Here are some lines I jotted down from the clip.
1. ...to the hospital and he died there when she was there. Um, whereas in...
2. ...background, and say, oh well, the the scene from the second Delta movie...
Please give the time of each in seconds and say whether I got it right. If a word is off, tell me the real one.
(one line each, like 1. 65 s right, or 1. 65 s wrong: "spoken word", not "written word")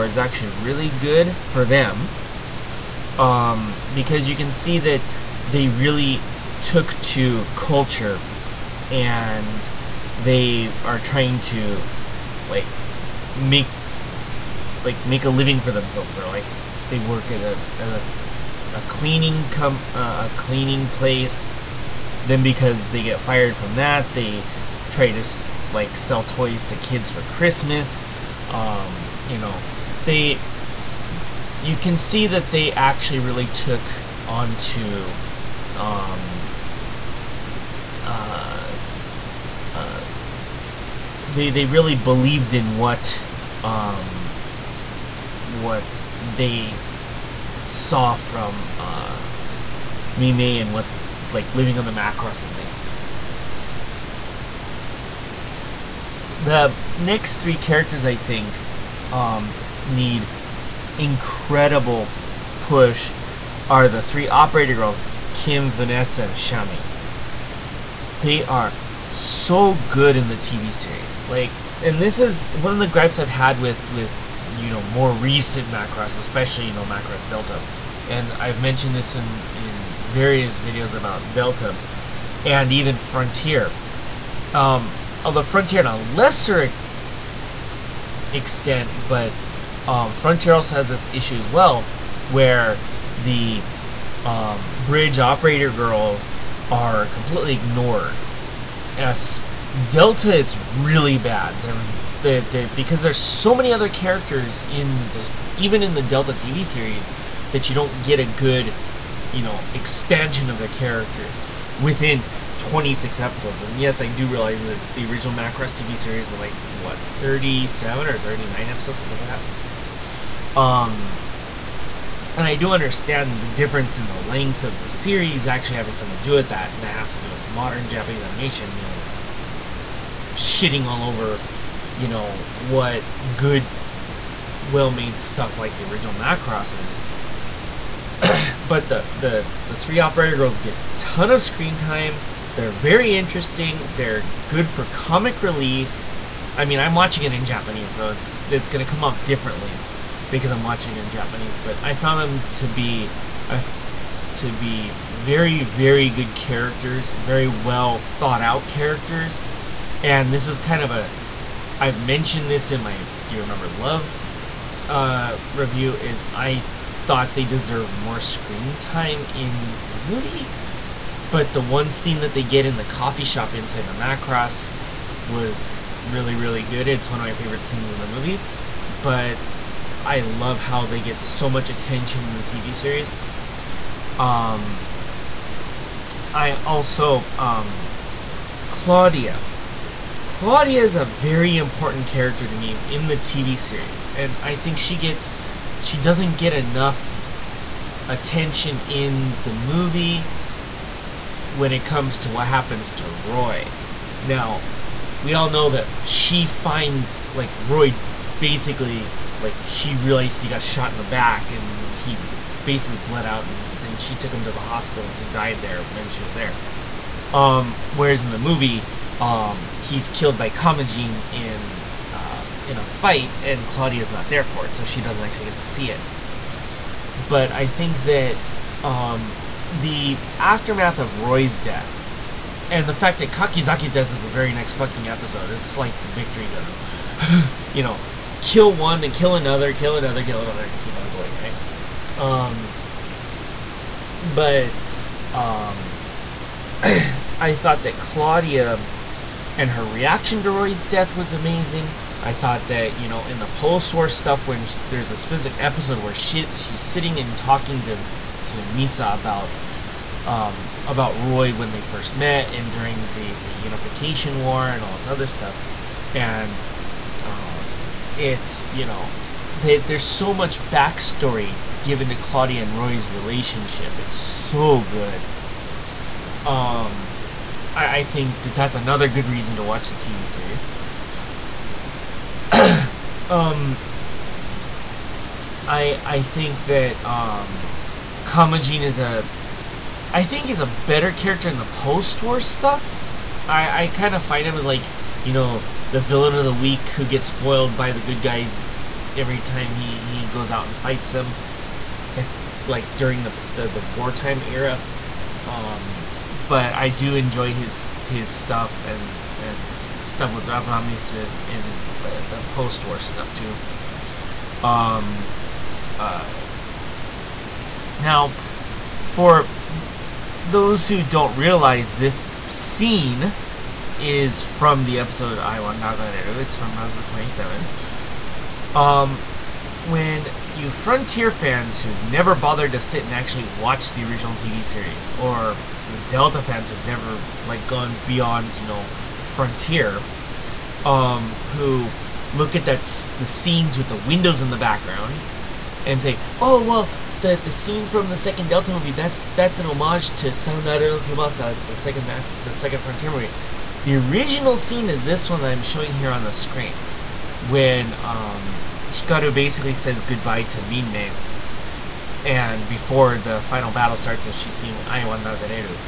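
1. 214 s right
2. 344 s right.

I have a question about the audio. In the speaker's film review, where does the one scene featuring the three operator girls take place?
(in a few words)
Coffee shop.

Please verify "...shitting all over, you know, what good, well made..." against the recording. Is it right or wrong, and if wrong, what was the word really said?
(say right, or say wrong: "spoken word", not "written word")
right.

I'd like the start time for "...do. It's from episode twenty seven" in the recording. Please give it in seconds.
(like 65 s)
326 s.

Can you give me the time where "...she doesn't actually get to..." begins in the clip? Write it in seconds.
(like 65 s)
224 s.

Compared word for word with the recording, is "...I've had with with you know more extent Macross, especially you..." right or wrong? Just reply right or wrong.
wrong.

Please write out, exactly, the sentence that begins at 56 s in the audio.
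The next three characters, I think, um, need incredible push are the three operator girls, Kim, Vanessa, and Shammy.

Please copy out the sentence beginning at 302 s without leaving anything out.
At, like during the the, the wartime era.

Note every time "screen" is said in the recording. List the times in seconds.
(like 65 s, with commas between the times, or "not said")
141 s, 168 s, 356 s.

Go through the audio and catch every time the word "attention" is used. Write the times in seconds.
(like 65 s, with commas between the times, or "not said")
181 s, 198 s.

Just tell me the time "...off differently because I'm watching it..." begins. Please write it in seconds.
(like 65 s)
149 s.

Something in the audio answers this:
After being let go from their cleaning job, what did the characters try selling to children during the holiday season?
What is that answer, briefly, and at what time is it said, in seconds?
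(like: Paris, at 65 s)
Toys, at 26 s.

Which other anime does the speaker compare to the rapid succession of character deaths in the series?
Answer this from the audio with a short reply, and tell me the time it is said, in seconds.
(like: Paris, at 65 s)
Victory Gundam, at 235 s.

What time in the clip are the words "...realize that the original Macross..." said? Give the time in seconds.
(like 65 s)
114 s.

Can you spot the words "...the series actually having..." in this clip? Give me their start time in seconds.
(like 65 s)
124 s.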